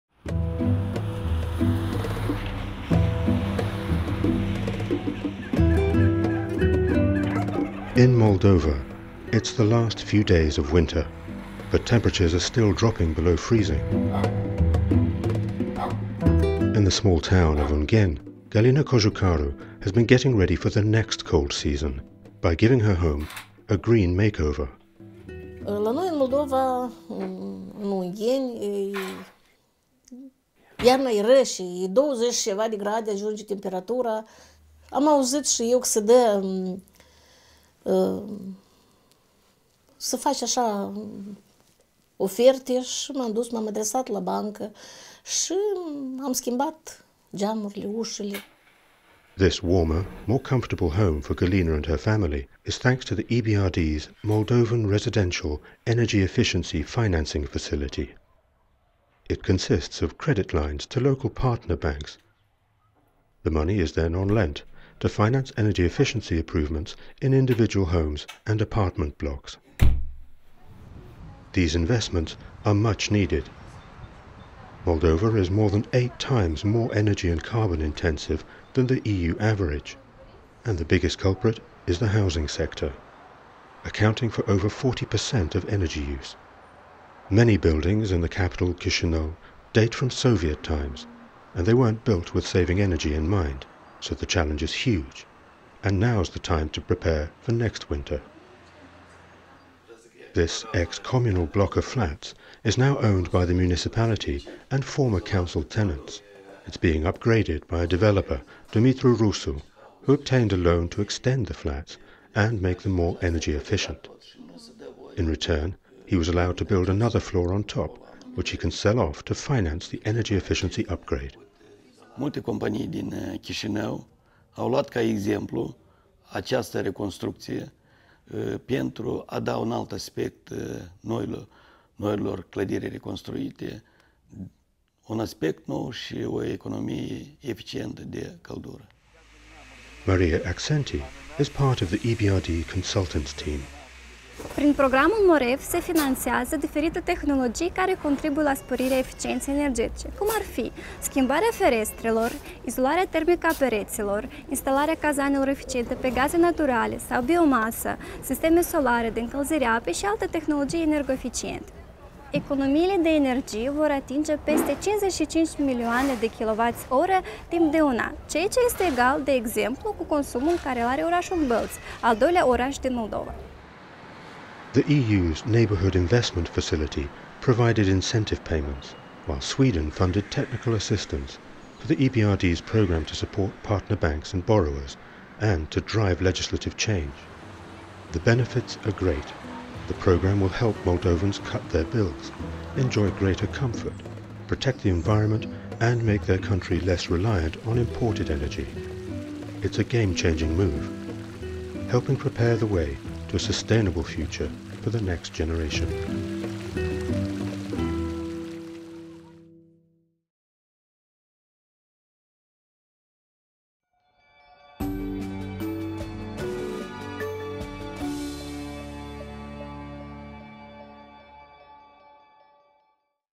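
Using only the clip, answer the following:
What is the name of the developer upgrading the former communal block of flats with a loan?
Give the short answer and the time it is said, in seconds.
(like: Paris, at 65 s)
Dumitru Rusu, at 108 s.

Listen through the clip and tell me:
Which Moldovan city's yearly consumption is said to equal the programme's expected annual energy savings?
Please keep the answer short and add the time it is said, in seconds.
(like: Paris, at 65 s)
Bălți, at 171 s.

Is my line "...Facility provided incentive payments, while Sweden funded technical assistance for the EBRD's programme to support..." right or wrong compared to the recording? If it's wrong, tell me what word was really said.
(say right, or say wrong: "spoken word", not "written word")
right.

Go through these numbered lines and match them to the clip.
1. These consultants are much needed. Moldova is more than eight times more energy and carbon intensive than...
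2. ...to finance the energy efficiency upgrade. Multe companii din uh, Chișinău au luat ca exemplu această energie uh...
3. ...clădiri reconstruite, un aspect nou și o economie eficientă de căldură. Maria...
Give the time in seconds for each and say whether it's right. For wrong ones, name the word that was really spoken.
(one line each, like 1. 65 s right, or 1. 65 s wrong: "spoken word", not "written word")
1. 71 s wrong: "investments", not "consultants"
2. 119 s wrong: "reconstrucție", not "energie"
3. 132 s right.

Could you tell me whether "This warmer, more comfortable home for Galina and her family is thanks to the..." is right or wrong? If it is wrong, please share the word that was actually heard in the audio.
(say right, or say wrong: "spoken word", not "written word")
right.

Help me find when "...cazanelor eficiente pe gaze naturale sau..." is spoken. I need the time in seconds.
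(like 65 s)
155 s.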